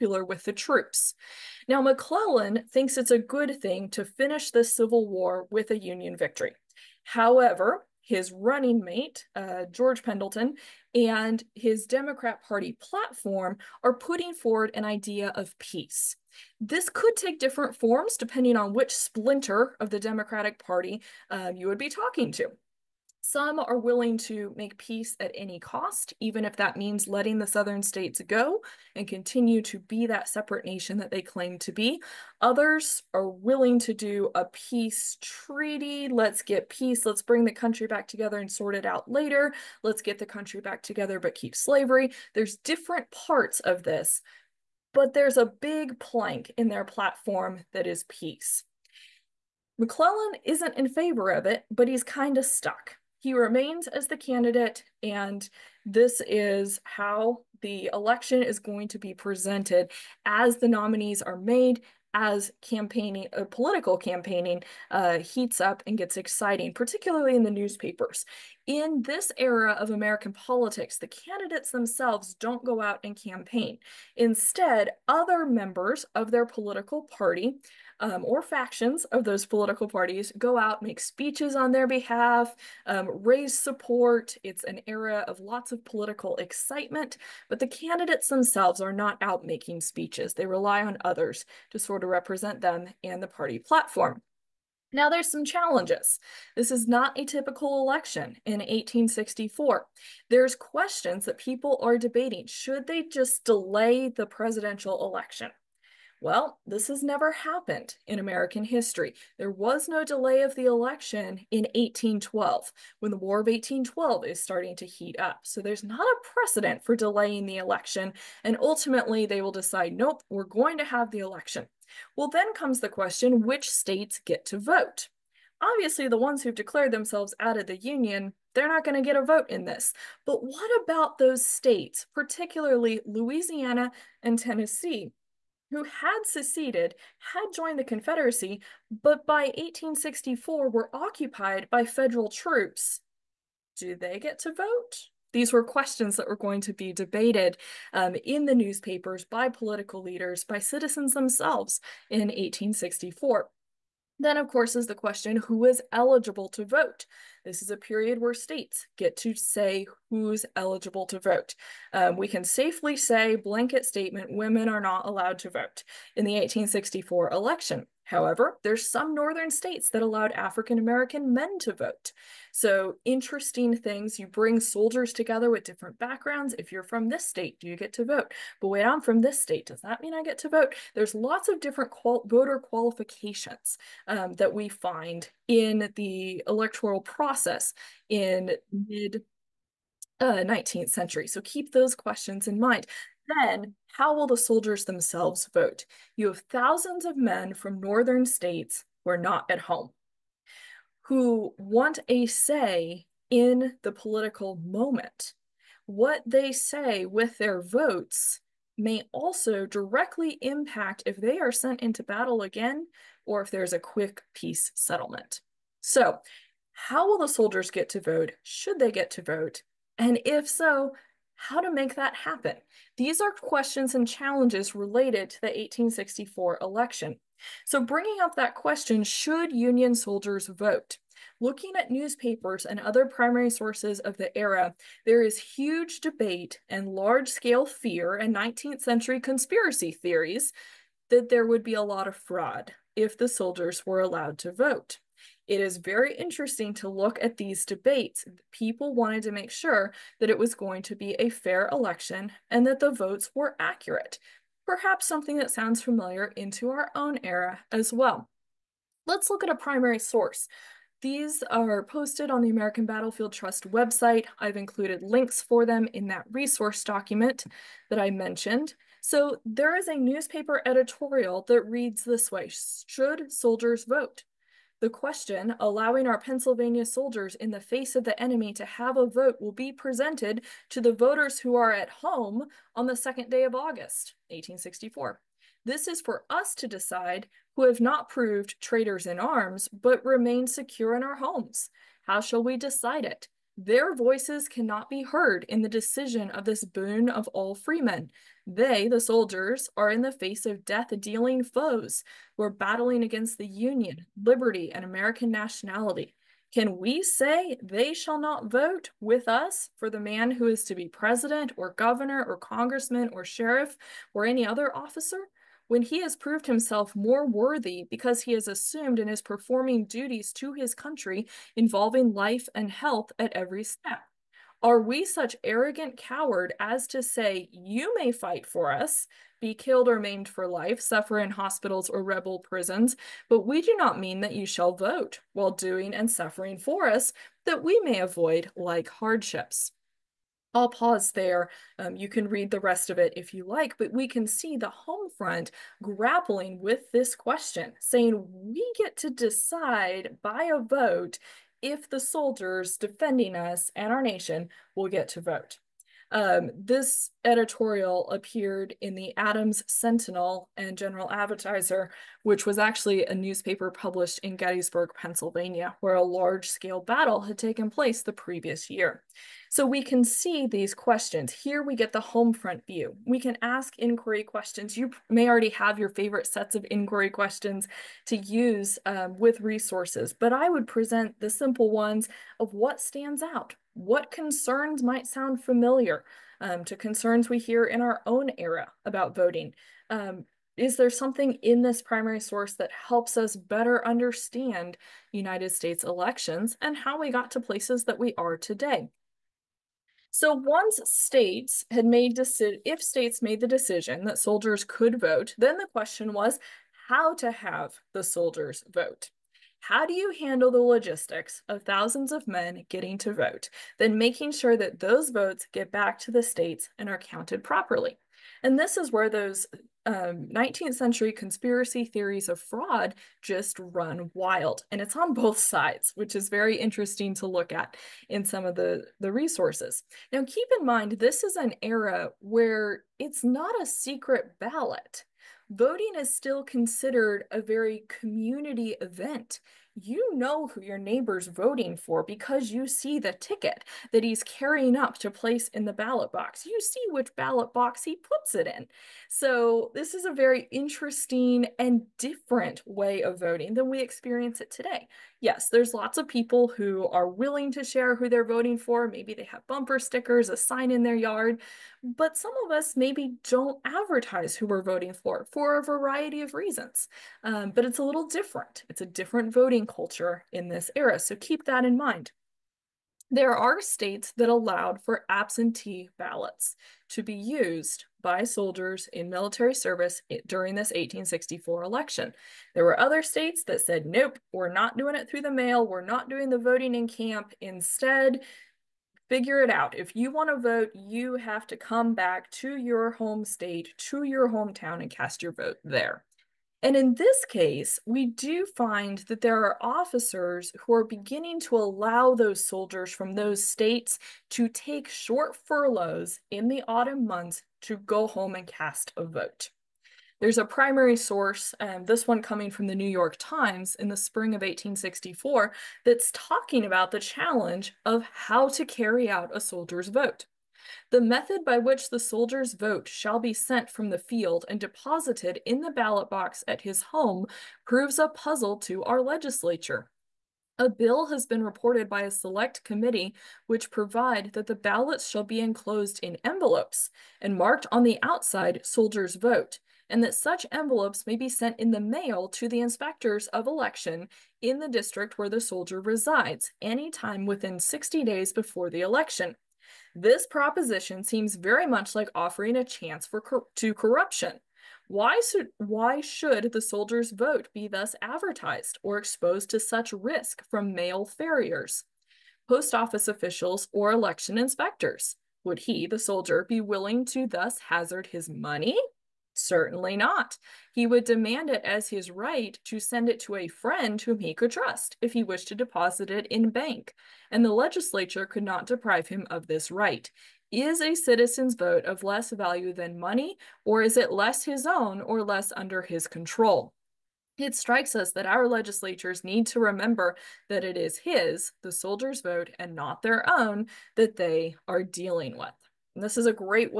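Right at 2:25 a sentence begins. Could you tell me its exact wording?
These were questions that were going to be debated um, in the newspapers by political leaders, by citizens themselves in 1864.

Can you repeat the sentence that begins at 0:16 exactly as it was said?
This could take different forms depending on which splinter of the Democratic Party uh, you would be talking to.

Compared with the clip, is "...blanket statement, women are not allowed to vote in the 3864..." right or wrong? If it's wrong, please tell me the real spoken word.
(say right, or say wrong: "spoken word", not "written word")
wrong: "1864", not "3864".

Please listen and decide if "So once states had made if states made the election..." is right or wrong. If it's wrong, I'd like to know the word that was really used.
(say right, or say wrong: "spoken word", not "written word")
wrong: "decision", not "election".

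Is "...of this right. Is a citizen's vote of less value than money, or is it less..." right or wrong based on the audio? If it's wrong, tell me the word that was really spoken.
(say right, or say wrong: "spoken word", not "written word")
right.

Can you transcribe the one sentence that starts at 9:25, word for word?
Would he, the soldier, be willing to thus hazard his money?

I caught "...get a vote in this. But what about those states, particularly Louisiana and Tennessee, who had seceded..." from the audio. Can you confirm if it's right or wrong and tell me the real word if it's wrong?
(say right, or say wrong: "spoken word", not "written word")
right.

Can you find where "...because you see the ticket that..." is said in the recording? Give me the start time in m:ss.
7:22.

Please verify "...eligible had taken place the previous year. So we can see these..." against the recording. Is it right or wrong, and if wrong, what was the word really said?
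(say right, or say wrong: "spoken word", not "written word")
wrong: "battle", not "eligible".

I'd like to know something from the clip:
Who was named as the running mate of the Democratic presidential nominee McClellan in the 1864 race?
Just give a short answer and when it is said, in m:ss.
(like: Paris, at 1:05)
George Pendleton, at 0:09.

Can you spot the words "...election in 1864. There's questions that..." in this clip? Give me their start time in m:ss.
1:37.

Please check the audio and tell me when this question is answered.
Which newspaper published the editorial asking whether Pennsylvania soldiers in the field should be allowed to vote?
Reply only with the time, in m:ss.
5:59.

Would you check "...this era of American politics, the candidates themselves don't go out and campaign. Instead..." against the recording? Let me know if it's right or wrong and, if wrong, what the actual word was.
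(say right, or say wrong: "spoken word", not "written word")
right.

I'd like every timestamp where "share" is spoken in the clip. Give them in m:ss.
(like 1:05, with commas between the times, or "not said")
7:37.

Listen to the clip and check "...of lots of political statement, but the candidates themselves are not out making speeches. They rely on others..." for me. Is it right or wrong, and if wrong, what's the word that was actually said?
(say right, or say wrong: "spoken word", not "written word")
wrong: "excitement", not "statement".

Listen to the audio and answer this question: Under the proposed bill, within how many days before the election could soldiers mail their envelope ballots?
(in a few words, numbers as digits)
60.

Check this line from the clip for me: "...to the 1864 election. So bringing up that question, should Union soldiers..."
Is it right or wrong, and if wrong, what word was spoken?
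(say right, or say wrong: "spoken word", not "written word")
right.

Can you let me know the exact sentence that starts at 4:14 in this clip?
Perhaps something that sounds familiar into our own era as well.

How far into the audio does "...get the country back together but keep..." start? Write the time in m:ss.
0:40.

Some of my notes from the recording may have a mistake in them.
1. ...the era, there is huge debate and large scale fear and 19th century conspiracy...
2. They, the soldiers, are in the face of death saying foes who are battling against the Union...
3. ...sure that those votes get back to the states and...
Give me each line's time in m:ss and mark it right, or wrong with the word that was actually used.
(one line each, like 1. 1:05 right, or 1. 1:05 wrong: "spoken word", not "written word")
1. 3:54 right
2. 4:58 wrong: "dealing", not "saying"
3. 6:54 right.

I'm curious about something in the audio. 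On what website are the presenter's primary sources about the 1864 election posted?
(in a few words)
American Battlefield Trust.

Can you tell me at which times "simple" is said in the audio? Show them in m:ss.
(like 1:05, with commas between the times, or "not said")
6:21.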